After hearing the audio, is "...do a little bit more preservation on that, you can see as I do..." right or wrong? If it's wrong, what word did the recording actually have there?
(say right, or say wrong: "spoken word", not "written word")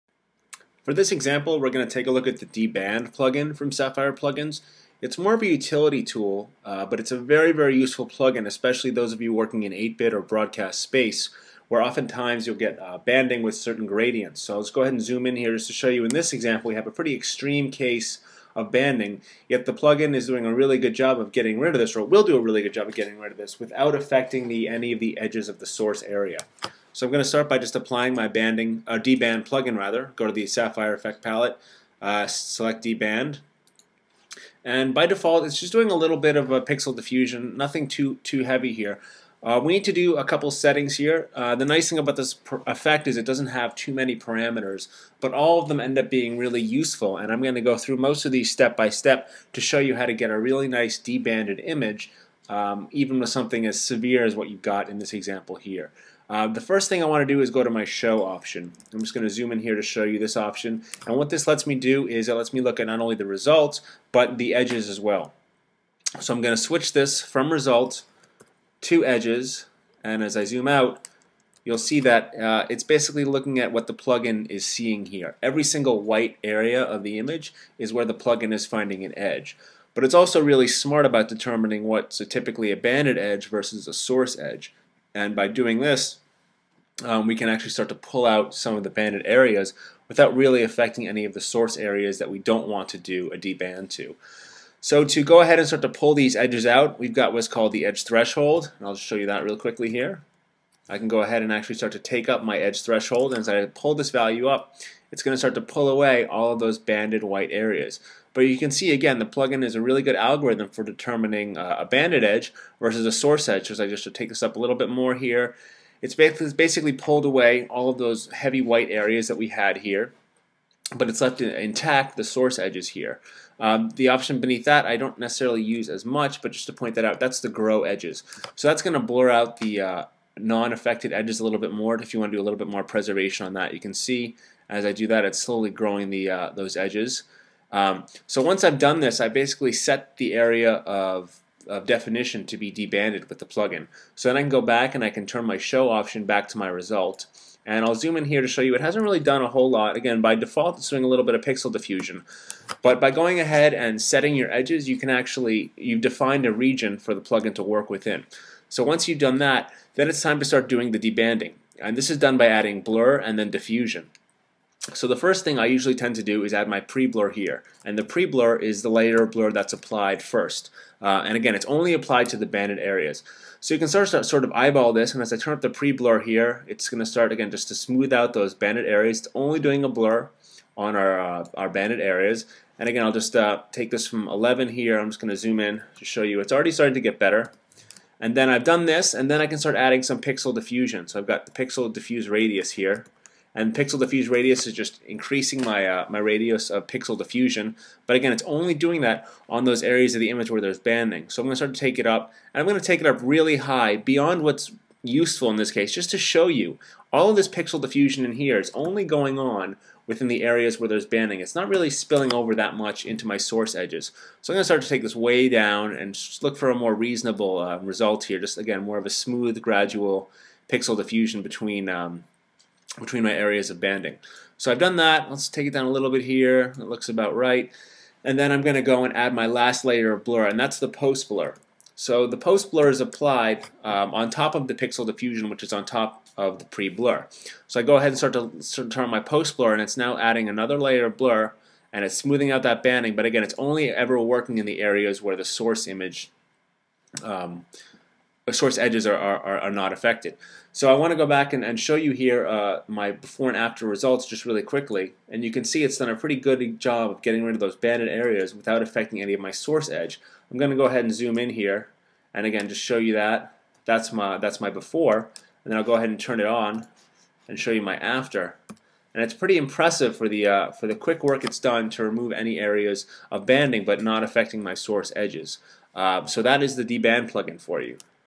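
right.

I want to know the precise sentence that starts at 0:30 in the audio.
Go to the Sapphire Effect palette, uh, select deband, and by default it's just doing a little bit of a pixel diffusion.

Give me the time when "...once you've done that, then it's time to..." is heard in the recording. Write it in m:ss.
2:38.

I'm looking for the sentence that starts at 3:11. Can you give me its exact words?
So I've got the pixel diffuse radius here and pixel diffuse radius is just increasing my, uh, my radius of pixel diffusion.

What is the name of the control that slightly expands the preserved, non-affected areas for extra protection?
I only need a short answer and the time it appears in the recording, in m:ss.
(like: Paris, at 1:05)
grow edges, at 2:07.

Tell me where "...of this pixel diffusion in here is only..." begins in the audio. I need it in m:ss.
3:27.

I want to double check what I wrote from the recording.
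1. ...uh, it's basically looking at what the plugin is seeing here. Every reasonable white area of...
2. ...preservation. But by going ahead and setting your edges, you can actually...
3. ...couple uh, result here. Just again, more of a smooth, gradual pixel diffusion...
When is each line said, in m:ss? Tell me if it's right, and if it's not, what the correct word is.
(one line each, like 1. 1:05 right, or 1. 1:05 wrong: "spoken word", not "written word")
1. 1:12 wrong: "single", not "reasonable"
2. 2:31 wrong: "diffusion", not "preservation"
3. 3:36 wrong: "reasonable", not "couple".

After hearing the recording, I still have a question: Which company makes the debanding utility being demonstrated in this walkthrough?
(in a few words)
Sapphire Plugins.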